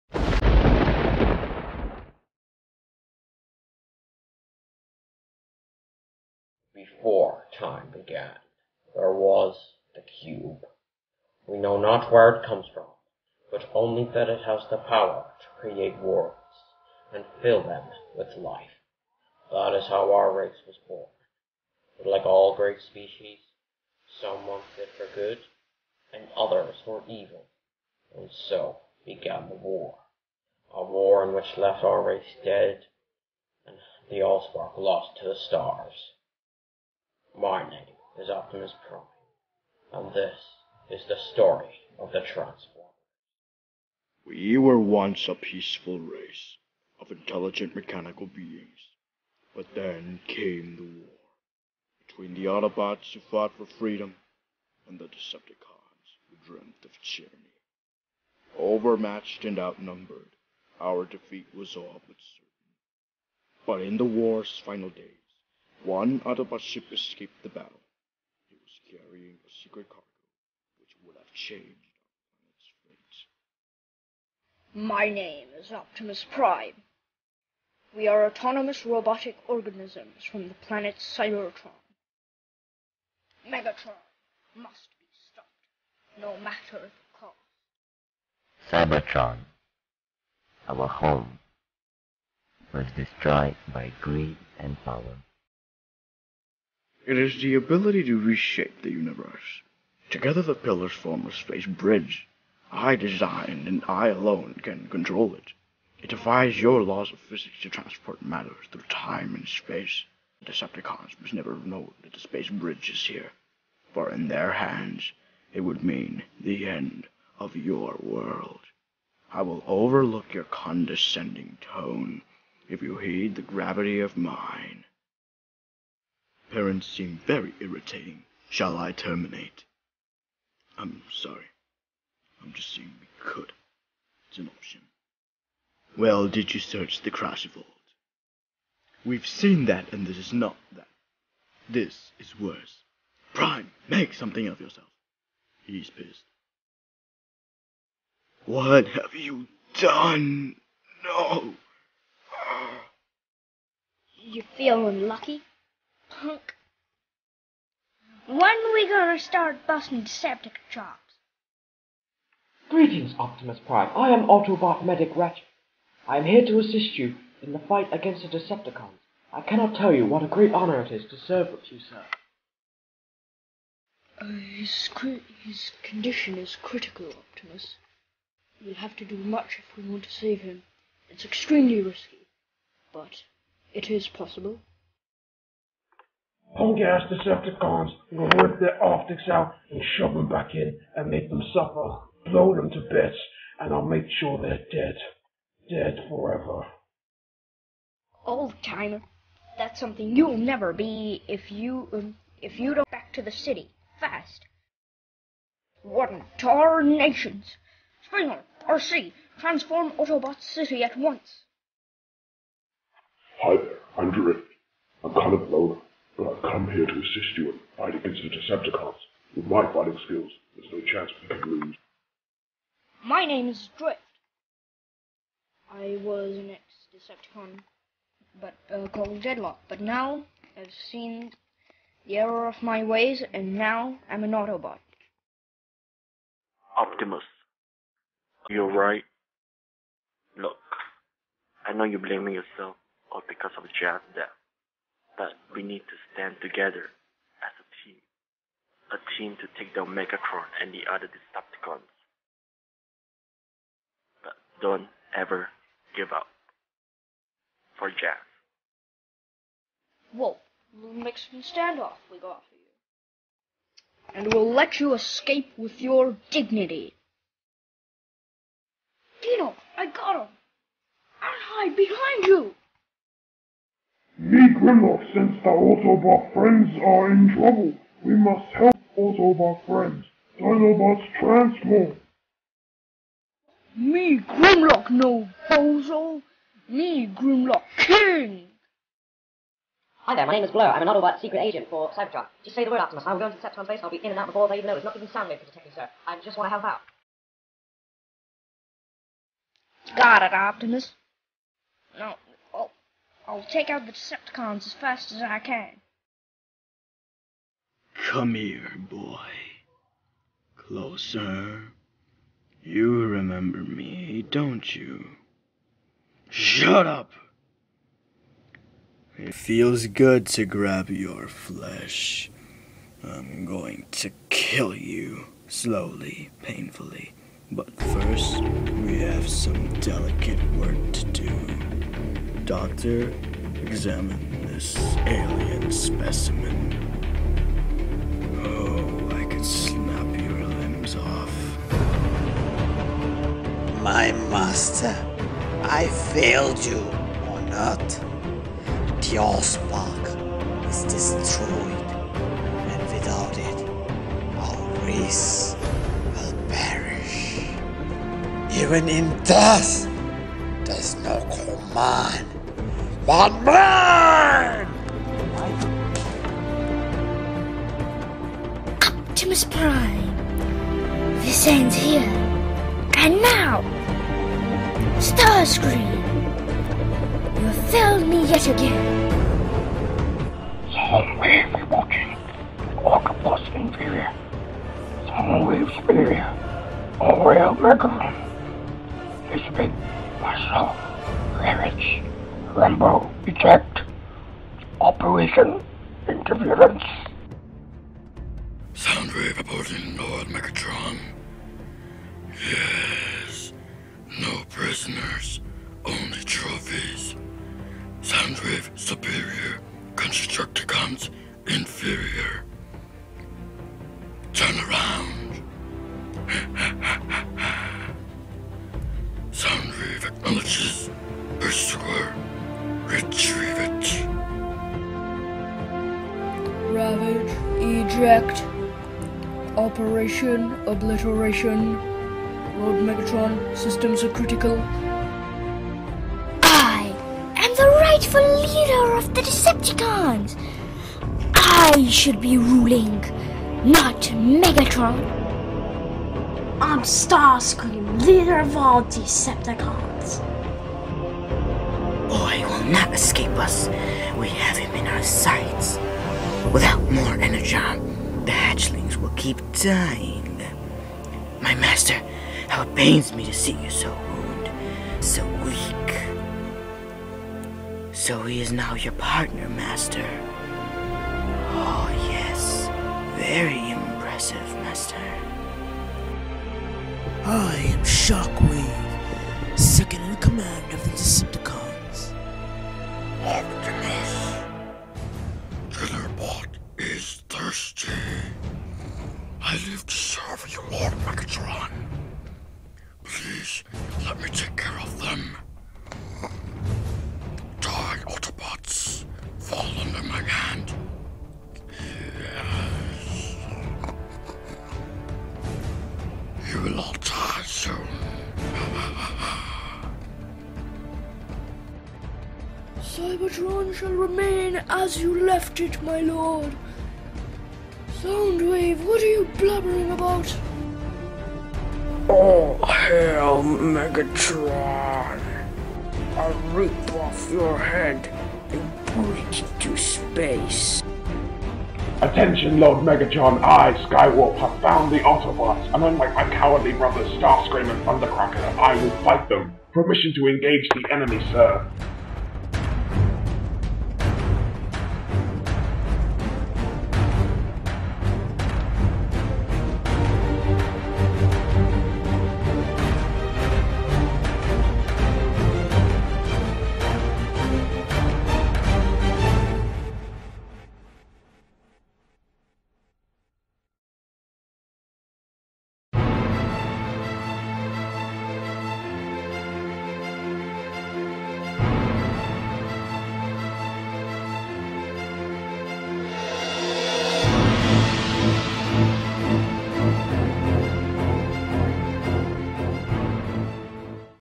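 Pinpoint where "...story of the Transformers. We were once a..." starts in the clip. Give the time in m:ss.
0:41.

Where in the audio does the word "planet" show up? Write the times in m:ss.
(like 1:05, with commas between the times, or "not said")
1:12, 1:20.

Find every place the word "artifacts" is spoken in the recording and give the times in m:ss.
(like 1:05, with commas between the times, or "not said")
not said.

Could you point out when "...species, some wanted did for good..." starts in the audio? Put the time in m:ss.
0:22.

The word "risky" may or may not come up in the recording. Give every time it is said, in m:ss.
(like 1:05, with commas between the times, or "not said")
3:01.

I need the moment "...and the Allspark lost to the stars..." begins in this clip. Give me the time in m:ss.
0:33.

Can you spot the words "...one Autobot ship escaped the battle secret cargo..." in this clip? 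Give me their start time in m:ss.
1:05.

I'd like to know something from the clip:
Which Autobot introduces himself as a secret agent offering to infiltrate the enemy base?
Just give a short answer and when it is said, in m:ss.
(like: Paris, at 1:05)
Blur, at 4:50.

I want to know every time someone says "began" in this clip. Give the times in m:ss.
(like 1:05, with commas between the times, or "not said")
0:07, 0:29.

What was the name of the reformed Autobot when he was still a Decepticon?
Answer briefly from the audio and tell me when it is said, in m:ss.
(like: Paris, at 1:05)
Deadlock, at 3:49.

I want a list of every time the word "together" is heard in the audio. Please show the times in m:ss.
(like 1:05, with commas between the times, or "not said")
1:40, 4:06.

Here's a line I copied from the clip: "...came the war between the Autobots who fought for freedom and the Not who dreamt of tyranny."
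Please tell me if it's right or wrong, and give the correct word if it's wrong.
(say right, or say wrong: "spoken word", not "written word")
wrong: "Decepticons", not "Not".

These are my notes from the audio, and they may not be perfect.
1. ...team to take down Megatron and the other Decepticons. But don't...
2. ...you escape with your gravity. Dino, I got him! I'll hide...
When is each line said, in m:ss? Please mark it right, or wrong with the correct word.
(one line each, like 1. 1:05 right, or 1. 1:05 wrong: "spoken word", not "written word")
1. 4:09 right
2. 4:24 wrong: "dignity", not "gravity".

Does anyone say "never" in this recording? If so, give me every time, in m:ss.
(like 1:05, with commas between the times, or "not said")
1:51, 3:20.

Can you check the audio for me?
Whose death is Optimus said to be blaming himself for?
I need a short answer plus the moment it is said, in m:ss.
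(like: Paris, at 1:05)
Jazz, at 4:03.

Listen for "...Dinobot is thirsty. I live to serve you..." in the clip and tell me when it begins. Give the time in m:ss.
8:05.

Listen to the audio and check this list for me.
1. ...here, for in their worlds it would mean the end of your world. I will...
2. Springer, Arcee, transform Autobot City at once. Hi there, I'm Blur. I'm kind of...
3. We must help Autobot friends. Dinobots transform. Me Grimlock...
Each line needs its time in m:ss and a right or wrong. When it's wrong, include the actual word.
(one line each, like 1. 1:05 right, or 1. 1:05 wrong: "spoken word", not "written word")
1. 1:53 wrong: "hands", not "worlds"
2. 3:28 wrong: "Drift", not "Blur"
3. 4:38 right.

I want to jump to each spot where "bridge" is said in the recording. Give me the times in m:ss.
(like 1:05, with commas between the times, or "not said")
1:41, 1:52.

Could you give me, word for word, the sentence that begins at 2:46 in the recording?
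I am here to assist you in the fight against the Decepticons.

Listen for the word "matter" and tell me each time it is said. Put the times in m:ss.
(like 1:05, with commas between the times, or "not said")
1:26, 1:48.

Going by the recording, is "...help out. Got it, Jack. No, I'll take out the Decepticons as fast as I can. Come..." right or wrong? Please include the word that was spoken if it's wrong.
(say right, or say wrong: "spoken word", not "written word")
wrong: "Optimus", not "Jack".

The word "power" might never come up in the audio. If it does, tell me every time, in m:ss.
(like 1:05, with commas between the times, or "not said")
0:14, 1:34.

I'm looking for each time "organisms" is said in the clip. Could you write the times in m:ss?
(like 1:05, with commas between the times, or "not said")
1:19.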